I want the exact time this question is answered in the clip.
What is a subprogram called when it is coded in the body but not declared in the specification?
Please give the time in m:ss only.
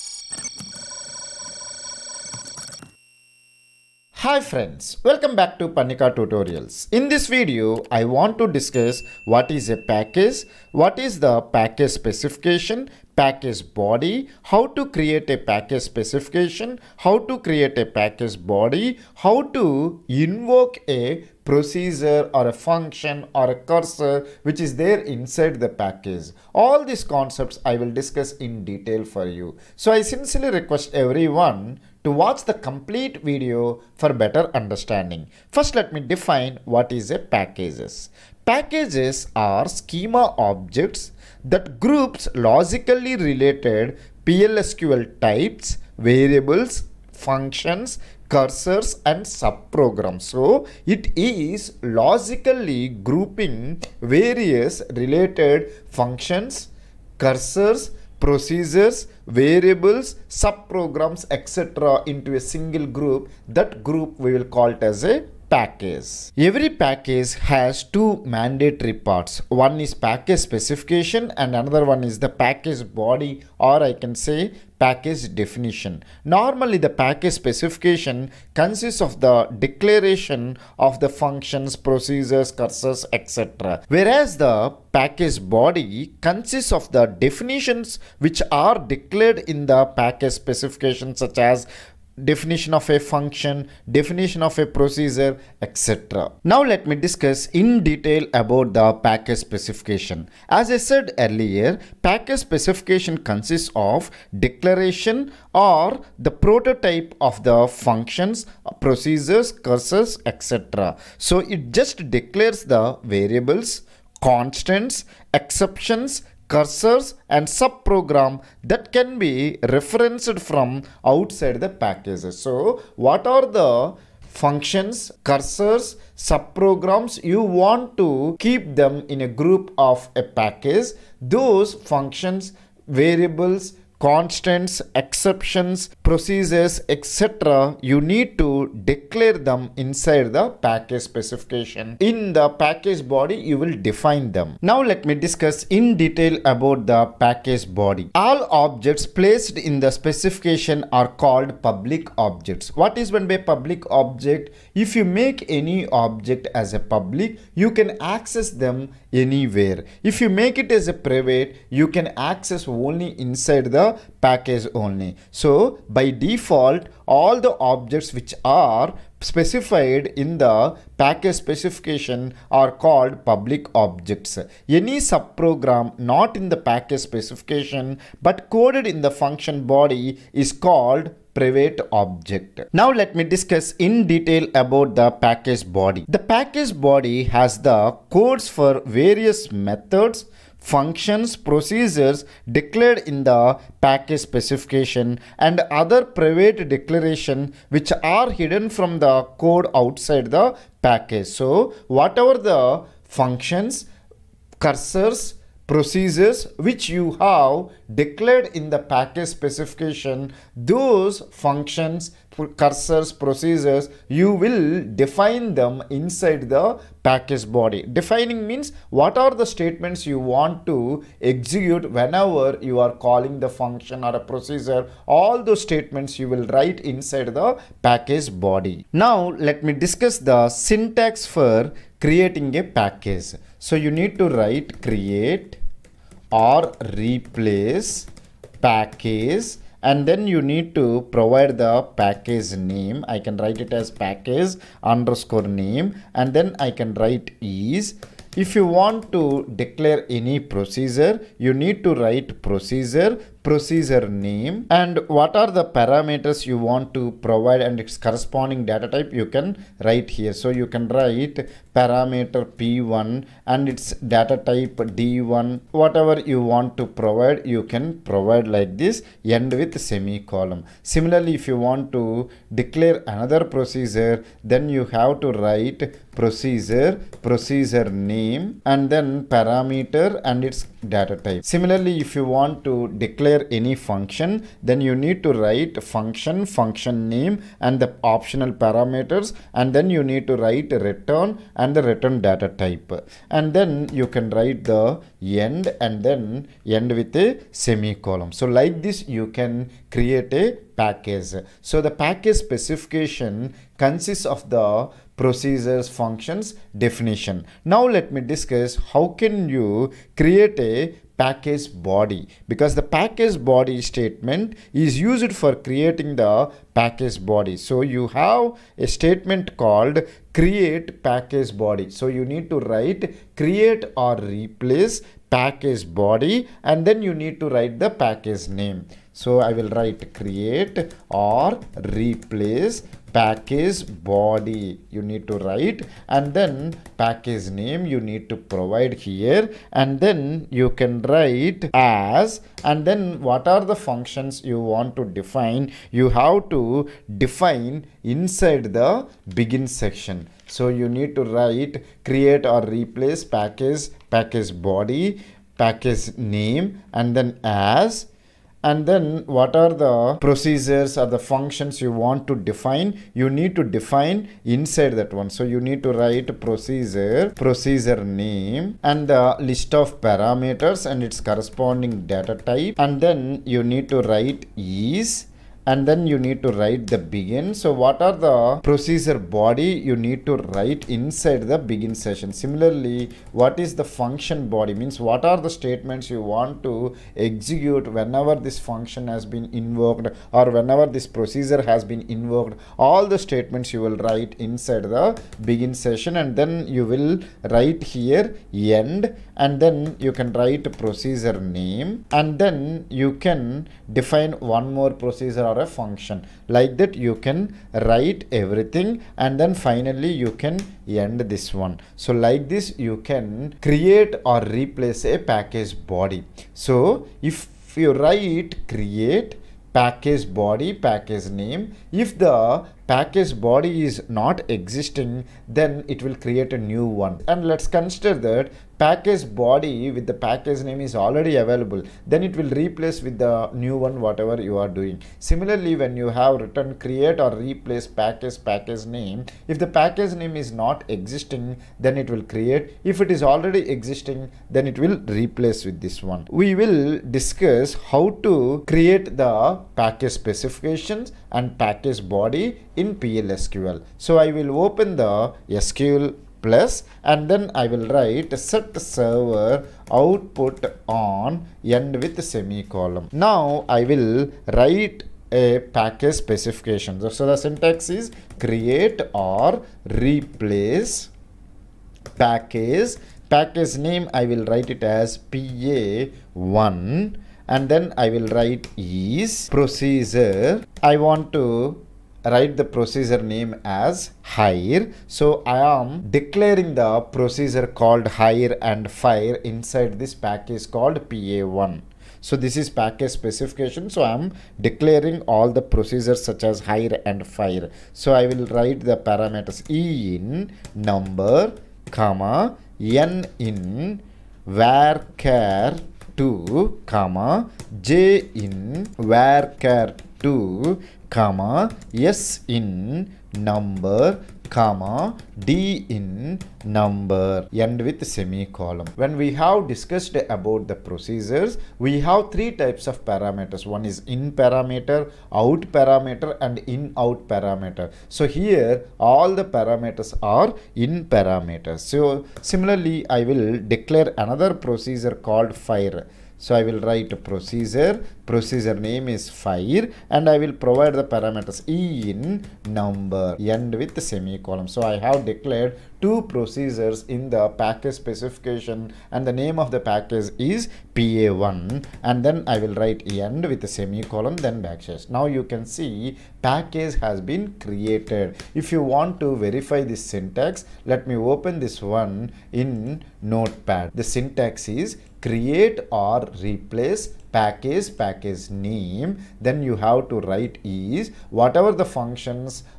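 3:01.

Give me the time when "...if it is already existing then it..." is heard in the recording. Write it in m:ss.
7:22.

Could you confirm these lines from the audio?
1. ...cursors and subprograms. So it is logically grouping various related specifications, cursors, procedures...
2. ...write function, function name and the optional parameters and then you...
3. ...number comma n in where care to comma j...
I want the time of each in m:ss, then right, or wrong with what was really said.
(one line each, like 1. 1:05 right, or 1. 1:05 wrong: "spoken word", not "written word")
1. 0:48 wrong: "functions", not "specifications"
2. 4:45 right
3. 8:20 right.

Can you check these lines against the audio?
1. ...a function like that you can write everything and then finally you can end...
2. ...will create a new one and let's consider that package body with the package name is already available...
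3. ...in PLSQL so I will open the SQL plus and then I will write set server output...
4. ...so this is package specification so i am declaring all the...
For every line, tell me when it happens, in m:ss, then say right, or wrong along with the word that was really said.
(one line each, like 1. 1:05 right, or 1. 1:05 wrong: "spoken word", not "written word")
1. 6:45 right
2. 7:06 right
3. 7:32 right
4. 8:12 right.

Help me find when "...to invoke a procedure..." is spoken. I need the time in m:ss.
0:19.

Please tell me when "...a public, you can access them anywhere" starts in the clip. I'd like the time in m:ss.
2:36.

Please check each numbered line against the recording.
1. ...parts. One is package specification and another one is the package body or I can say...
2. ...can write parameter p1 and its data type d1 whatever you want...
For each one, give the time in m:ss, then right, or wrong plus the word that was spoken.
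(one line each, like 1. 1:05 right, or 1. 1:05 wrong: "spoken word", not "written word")
1. 1:08 right
2. 4:20 right.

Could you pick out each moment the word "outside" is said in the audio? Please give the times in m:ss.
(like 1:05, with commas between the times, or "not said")
2:01, 3:19.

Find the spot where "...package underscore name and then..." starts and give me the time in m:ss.
4:03.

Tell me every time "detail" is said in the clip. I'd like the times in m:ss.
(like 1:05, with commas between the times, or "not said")
0:28, 1:37, 2:25, 3:04.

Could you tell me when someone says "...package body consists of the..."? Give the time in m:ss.
1:24.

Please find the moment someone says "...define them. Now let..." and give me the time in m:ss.
2:23.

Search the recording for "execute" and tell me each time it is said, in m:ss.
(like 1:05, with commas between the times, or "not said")
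3:41, 6:27.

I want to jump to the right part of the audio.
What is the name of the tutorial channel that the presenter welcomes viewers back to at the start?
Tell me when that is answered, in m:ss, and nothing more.
0:05.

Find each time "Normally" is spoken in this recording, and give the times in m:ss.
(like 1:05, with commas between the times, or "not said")
1:16.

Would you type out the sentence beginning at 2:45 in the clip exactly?
So by default, all the objects which are specified in the package specification are called public objects.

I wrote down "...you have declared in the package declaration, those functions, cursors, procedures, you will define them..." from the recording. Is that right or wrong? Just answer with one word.
wrong.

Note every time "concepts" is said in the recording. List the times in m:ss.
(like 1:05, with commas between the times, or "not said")
0:27.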